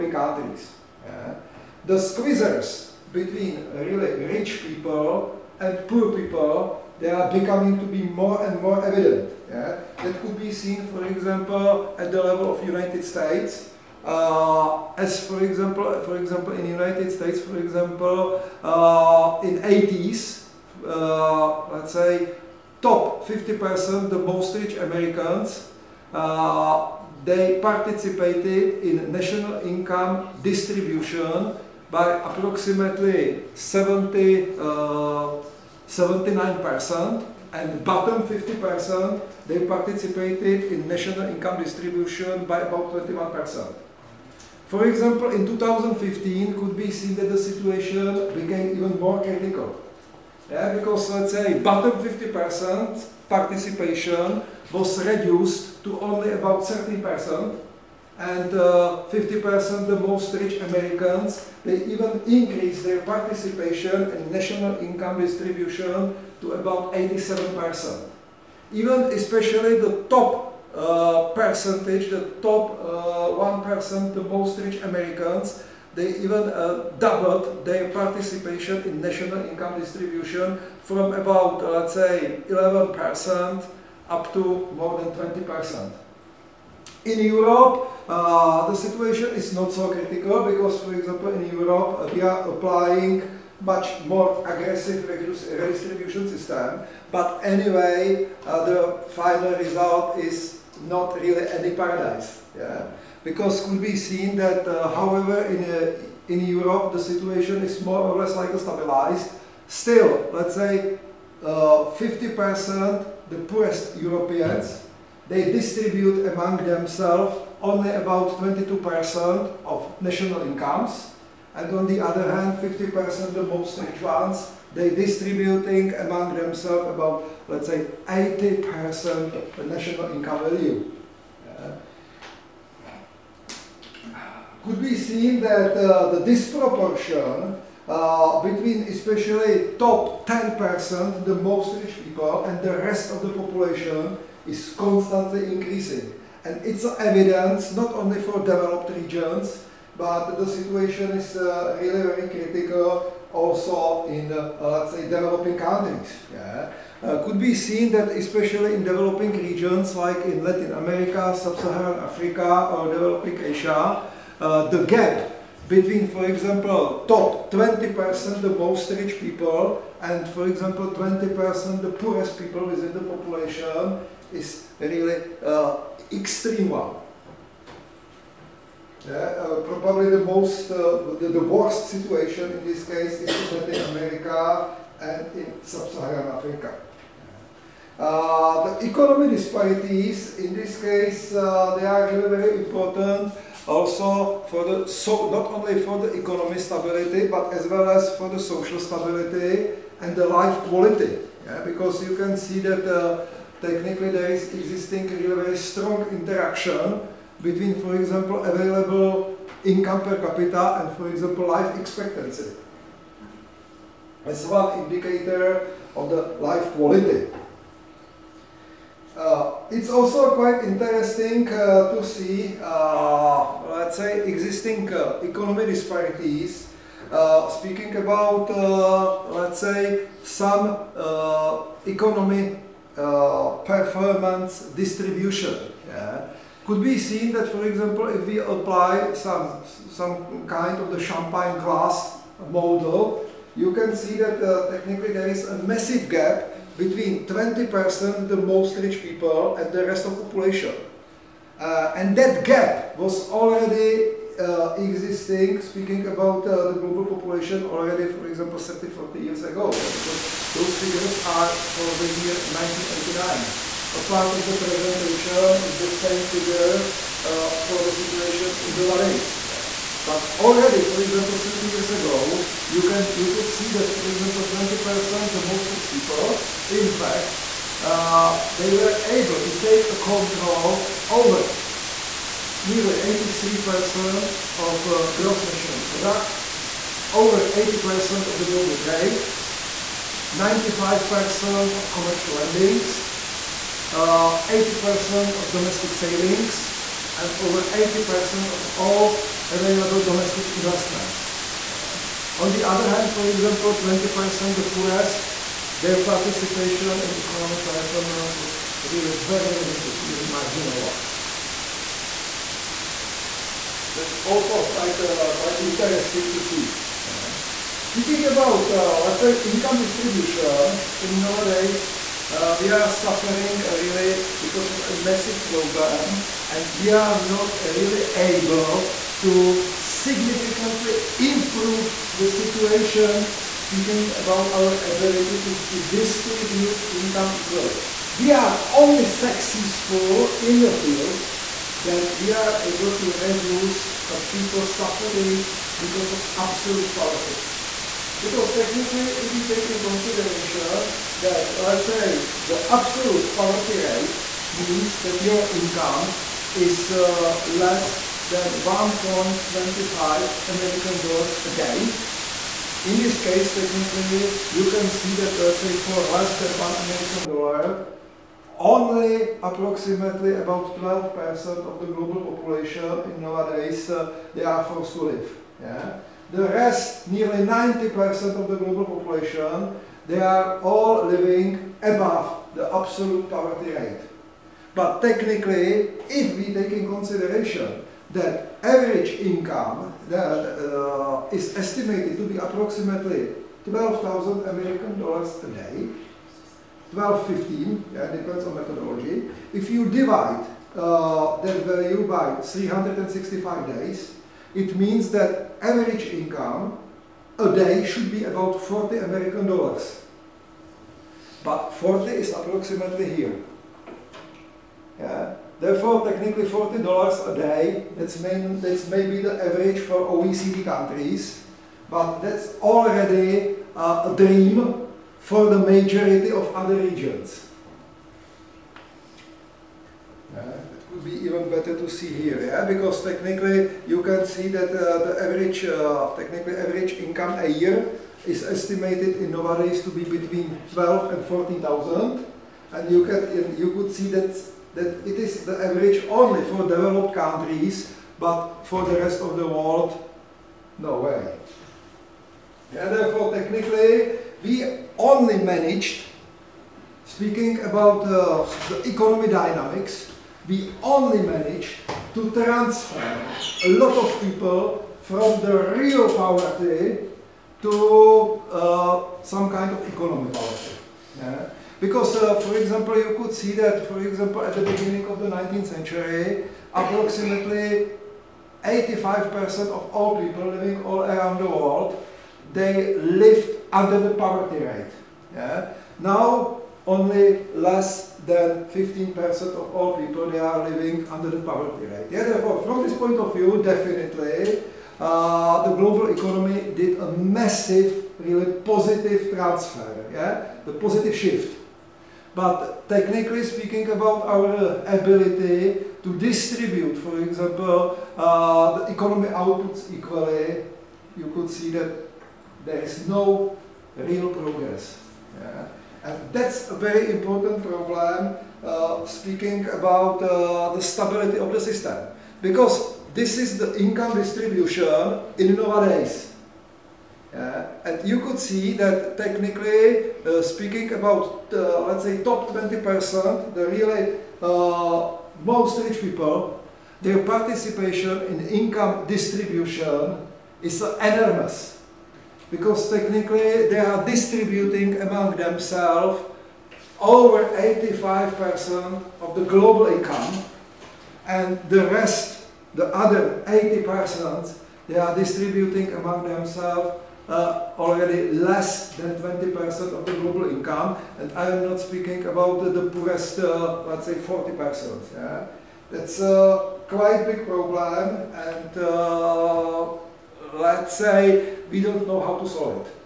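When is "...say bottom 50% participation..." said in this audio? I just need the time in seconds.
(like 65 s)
51 s.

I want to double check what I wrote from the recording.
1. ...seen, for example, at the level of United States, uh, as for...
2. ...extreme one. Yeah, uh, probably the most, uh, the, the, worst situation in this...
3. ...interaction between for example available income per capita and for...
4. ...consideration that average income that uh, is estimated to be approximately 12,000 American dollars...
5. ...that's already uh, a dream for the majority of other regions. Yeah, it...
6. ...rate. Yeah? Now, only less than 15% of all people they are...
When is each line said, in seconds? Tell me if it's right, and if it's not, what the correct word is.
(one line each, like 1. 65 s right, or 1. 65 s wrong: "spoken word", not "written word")
1. 10 s right
2. 176 s right
3. 206 s right
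4. 386 s right
5. 422 s right
6. 484 s right.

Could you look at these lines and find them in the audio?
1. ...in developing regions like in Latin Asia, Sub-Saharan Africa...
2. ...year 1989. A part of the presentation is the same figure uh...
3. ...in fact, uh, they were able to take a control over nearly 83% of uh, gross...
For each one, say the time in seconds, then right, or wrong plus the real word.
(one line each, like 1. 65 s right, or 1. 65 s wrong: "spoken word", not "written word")
1. 158 s wrong: "America", not "Asia"
2. 262 s right
3. 276 s right.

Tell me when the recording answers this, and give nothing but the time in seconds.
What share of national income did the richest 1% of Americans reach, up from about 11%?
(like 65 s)
84 s.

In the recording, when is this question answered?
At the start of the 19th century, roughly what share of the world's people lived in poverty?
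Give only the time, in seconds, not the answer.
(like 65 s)
476 s.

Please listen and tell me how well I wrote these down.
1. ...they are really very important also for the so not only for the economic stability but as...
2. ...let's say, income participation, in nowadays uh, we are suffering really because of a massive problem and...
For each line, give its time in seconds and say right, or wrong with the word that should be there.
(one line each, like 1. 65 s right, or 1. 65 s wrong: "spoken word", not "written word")
1. 191 s right
2. 319 s wrong: "distribution", not "participation".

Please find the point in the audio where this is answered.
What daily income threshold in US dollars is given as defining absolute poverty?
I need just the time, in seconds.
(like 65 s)
358 s.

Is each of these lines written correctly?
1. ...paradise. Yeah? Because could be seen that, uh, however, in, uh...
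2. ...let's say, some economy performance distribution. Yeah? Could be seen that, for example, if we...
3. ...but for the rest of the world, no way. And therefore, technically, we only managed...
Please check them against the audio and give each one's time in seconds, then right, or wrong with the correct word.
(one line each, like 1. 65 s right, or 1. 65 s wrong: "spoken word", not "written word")
1. 101 s right
2. 229 s right
3. 448 s right.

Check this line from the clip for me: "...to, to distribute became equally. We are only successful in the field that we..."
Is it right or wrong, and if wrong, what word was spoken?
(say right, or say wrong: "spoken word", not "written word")
wrong: "income", not "became".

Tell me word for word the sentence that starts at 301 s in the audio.
Uh, on the other hand, for example, 20% the poorest their participation in economic performance was really very limited, nearly marginal one.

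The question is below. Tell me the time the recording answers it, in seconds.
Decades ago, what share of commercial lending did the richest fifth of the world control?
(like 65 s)
290 s.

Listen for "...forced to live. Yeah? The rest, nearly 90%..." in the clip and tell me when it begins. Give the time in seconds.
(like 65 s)
374 s.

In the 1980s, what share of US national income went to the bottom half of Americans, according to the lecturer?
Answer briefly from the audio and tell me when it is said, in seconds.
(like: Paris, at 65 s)
21%, at 42 s.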